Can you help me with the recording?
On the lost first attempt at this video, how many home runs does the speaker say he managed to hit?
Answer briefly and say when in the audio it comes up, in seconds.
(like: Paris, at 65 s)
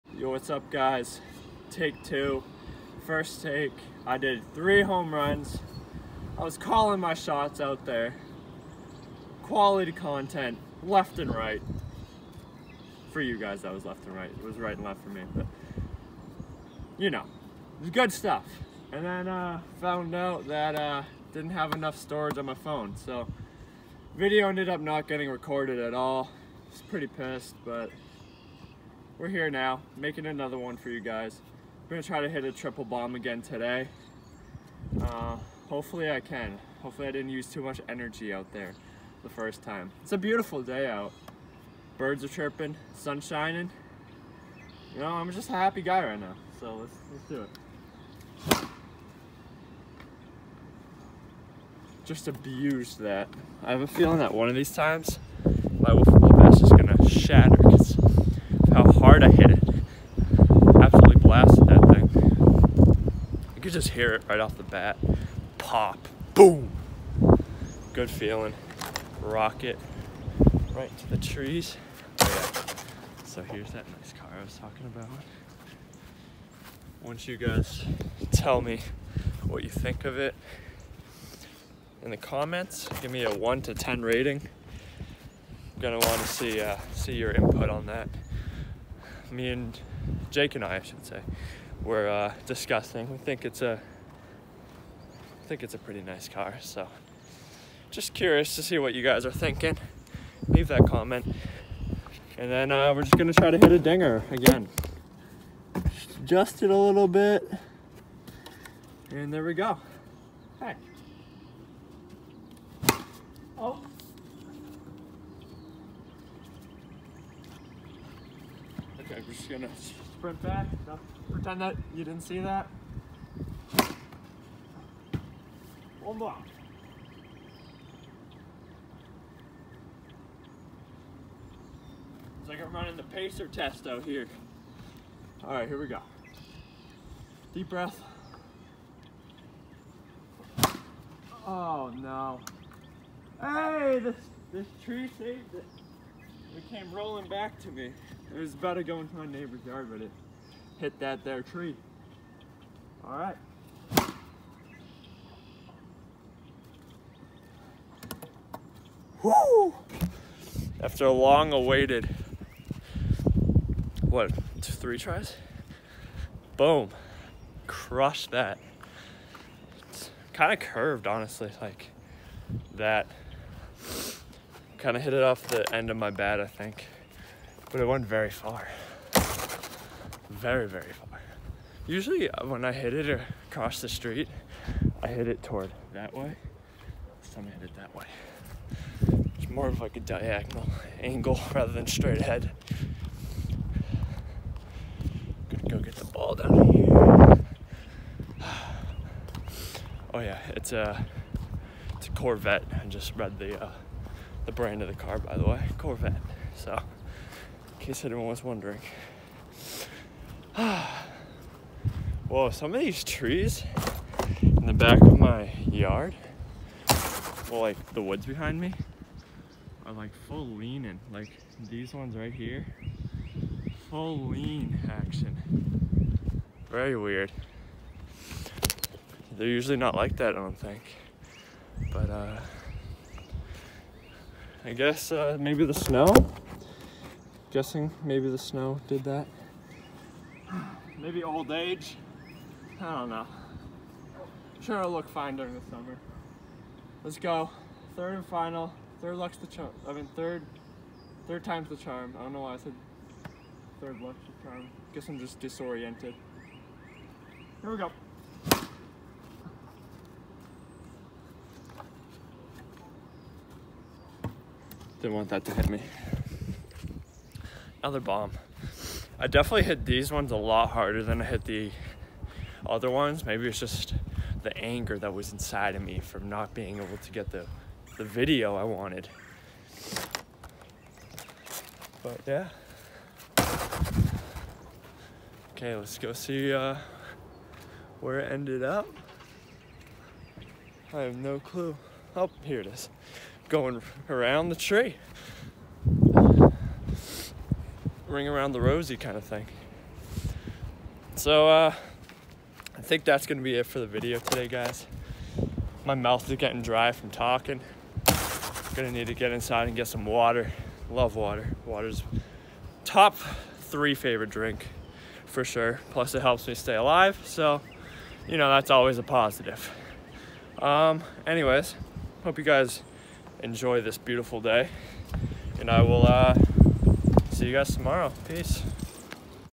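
3, at 4 s.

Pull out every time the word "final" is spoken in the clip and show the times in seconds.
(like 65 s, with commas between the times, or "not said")
248 s.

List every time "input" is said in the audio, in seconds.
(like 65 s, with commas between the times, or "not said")
87 s.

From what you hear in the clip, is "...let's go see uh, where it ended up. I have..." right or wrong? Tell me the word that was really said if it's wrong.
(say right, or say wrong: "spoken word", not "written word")
right.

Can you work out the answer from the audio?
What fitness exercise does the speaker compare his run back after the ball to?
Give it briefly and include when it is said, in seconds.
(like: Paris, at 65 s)
pacer test, at 133 s.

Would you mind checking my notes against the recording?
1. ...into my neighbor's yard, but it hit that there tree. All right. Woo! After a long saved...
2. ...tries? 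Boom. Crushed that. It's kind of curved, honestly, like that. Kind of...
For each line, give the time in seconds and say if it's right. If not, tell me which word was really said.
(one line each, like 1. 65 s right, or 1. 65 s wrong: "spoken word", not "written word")
1. 148 s wrong: "awaited", not "saved"
2. 164 s right.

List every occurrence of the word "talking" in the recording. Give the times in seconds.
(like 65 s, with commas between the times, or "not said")
74 s, 307 s.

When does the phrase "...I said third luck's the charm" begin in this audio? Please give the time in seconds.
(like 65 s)
252 s.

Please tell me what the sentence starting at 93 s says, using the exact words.
We think it's a, I think it's a pretty nice car.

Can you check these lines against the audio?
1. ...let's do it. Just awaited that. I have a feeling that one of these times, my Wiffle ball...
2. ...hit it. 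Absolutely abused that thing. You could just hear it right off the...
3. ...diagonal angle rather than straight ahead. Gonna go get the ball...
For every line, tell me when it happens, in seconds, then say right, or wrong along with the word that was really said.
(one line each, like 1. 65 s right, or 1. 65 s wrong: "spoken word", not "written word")
1. 47 s wrong: "abused", not "awaited"
2. 59 s wrong: "blasted", not "abused"
3. 189 s right.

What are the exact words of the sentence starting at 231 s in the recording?
But, uh, I guess uh, maybe the snow.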